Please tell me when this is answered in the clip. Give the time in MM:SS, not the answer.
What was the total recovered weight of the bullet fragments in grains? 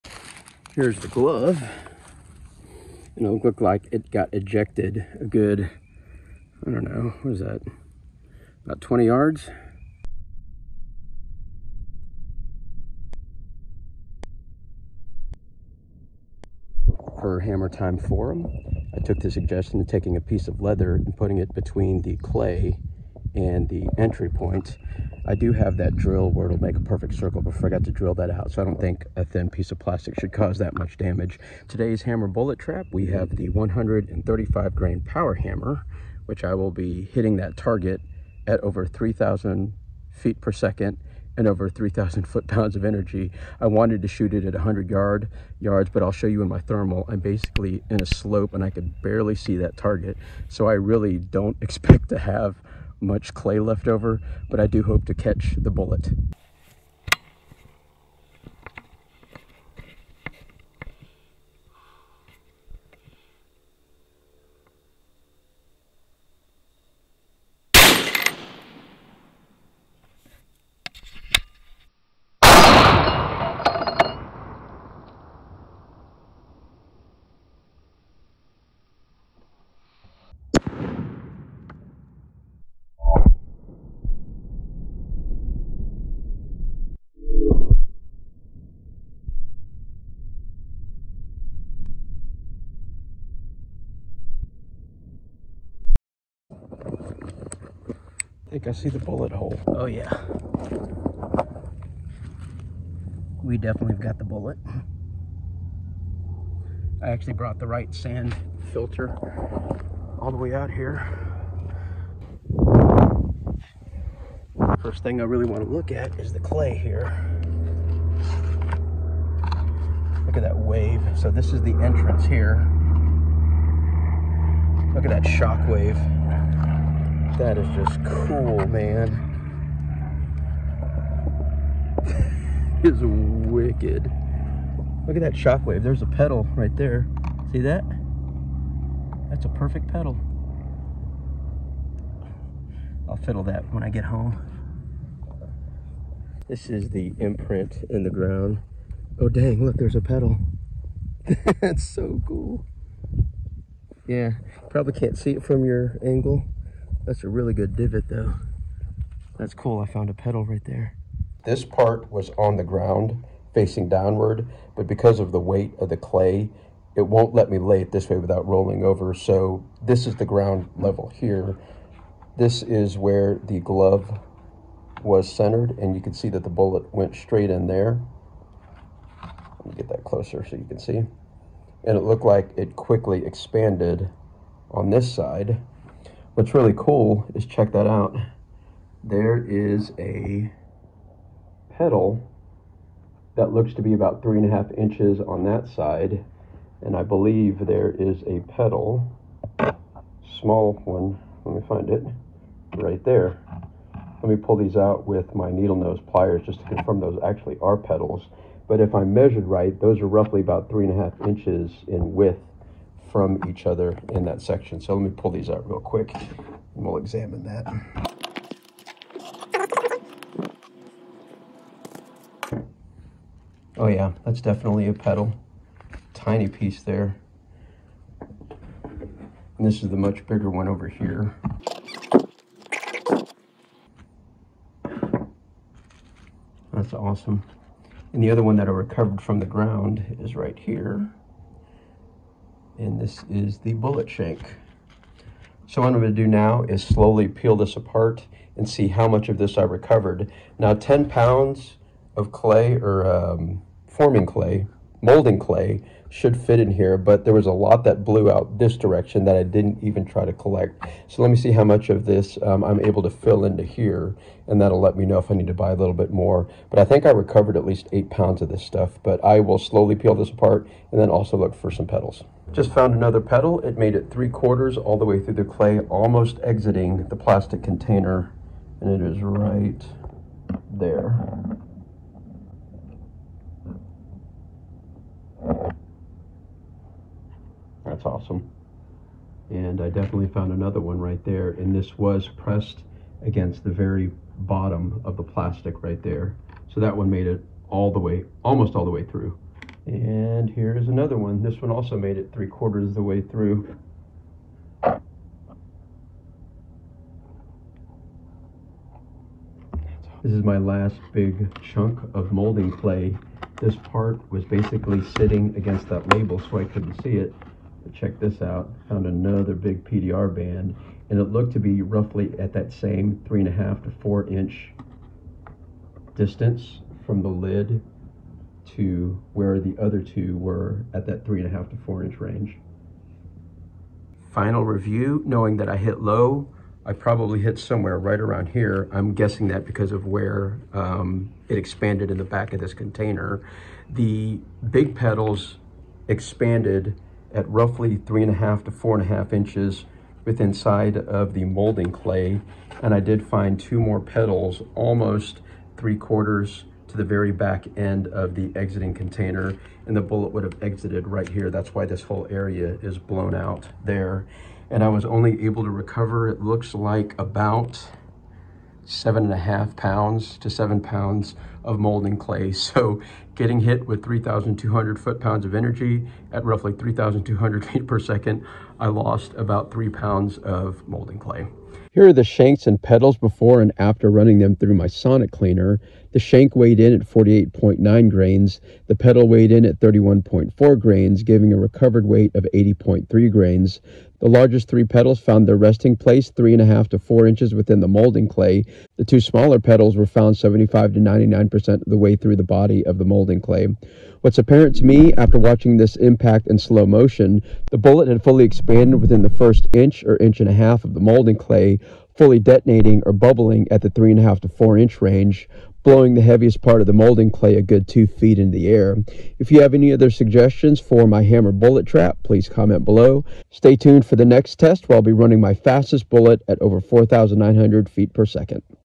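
06:32.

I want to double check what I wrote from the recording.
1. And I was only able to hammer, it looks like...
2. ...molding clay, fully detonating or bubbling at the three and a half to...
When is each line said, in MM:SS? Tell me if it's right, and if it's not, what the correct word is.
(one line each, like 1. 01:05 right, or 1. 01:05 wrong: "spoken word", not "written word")
1. 06:04 wrong: "recover", not "hammer"
2. 06:50 right.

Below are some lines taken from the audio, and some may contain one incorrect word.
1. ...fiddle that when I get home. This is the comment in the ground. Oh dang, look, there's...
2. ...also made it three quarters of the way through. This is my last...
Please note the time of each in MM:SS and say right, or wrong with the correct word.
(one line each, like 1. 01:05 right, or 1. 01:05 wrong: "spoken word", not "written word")
1. 02:23 wrong: "imprint", not "comment"
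2. 05:01 right.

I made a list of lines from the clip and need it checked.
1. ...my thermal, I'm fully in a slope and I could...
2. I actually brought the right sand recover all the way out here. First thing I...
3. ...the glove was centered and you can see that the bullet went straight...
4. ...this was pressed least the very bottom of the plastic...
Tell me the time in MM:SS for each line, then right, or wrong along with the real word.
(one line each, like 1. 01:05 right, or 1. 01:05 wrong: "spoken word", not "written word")
1. 00:46 wrong: "basically", not "fully"
2. 01:47 wrong: "filter", not "recover"
3. 02:53 right
4. 04:51 wrong: "against", not "least".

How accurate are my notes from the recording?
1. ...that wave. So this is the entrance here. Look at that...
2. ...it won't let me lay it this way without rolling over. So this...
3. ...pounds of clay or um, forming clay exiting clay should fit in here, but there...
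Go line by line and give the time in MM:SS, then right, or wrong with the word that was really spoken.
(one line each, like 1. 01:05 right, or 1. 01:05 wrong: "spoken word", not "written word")
1. 02:00 right
2. 02:46 right
3. 04:11 wrong: "molding", not "exiting".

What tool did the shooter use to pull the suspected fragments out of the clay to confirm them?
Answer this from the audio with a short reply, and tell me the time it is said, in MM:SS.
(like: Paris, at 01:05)
needle nose pliers, at 03:25.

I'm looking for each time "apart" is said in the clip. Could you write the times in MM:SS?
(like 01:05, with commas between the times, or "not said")
04:07, 04:30.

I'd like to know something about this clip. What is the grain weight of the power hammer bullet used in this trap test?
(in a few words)
135 grain.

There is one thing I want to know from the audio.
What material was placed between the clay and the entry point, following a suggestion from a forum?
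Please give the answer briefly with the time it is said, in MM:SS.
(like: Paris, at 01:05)
a piece of leather, at 00:20.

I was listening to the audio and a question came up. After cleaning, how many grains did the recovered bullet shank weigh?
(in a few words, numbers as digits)
48.9 grains.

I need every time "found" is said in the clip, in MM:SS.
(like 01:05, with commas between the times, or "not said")
02:39, 04:32, 04:50, 05:18, 06:35, 06:40.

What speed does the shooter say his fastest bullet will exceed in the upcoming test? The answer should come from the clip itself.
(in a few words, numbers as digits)
4,900 feet per second.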